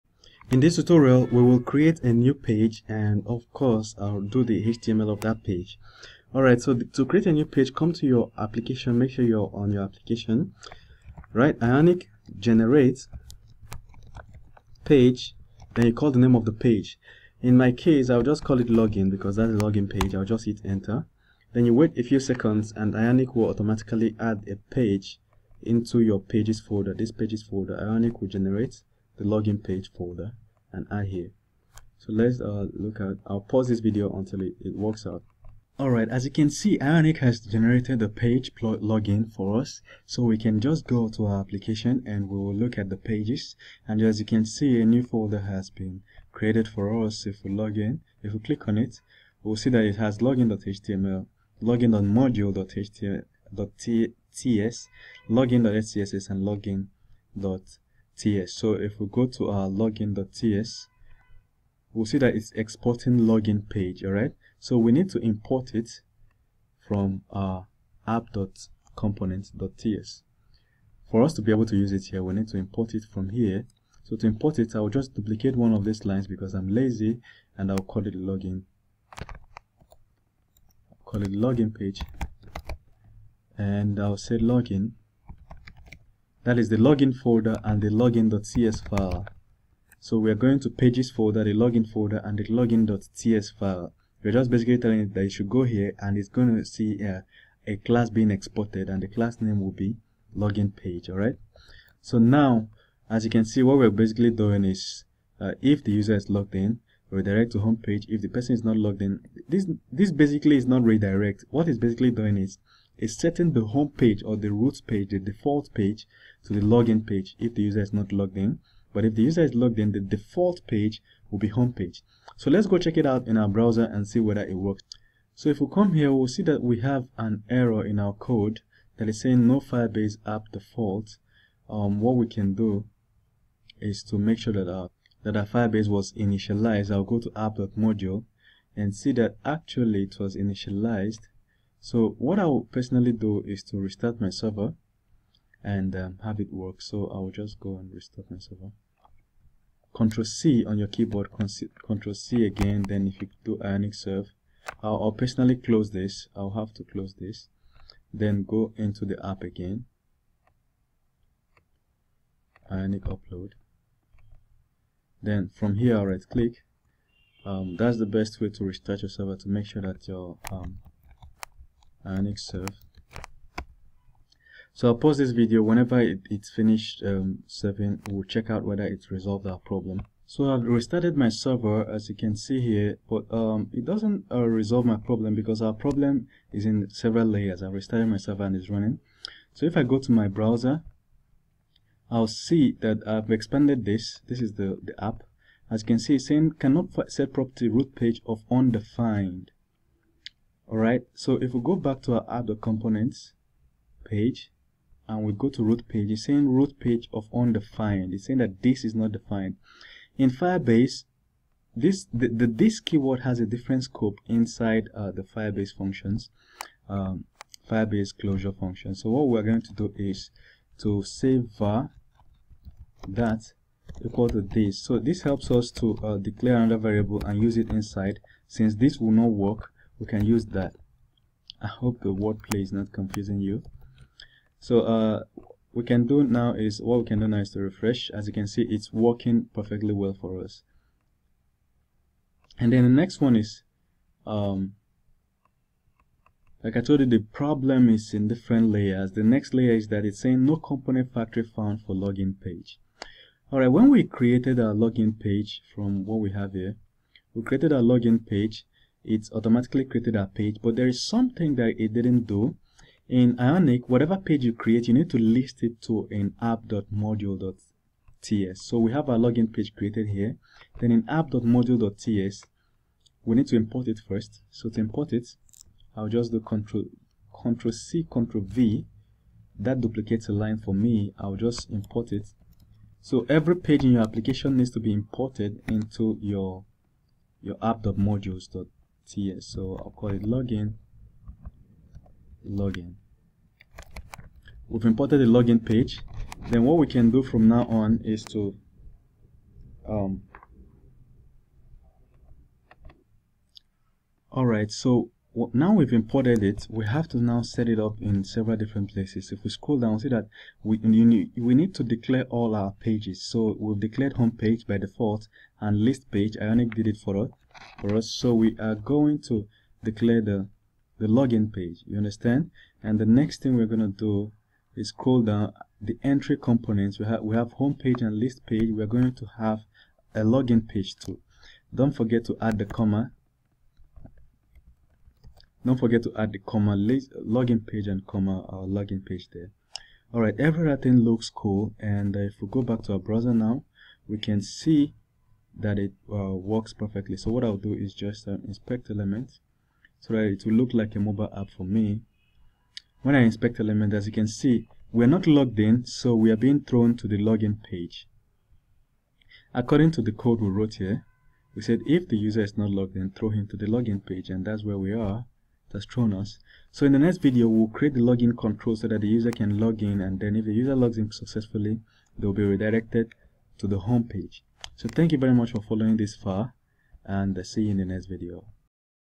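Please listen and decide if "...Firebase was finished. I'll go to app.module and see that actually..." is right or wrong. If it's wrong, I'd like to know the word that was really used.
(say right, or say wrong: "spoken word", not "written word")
wrong: "initialized", not "finished".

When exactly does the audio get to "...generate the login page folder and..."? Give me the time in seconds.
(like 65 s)
28 s.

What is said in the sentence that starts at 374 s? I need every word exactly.
So thank you very much for following this far, and I'll see you in the next video.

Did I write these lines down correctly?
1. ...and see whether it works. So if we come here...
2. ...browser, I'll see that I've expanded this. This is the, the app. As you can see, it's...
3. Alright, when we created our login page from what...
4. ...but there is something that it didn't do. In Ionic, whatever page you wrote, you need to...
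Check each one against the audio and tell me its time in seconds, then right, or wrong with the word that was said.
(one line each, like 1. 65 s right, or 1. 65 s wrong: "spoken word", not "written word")
1. 123 s right
2. 190 s right
3. 253 s right
4. 260 s wrong: "create", not "wrote".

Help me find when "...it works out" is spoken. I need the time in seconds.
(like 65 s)
34 s.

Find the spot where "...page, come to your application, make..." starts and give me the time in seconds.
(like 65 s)
7 s.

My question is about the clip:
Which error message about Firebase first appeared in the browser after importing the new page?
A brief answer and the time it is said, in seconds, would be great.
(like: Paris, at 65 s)
no Firebase app default, at 129 s.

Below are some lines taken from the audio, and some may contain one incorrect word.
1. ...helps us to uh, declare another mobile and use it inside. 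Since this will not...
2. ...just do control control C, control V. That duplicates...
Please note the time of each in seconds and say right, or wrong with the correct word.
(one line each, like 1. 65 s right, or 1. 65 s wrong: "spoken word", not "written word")
1. 225 s wrong: "variable", not "mobile"
2. 276 s right.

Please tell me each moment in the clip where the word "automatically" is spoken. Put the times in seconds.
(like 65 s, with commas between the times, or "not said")
23 s, 259 s.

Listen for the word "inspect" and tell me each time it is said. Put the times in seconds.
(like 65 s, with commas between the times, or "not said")
348 s, 353 s.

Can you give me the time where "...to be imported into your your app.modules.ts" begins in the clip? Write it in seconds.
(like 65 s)
284 s.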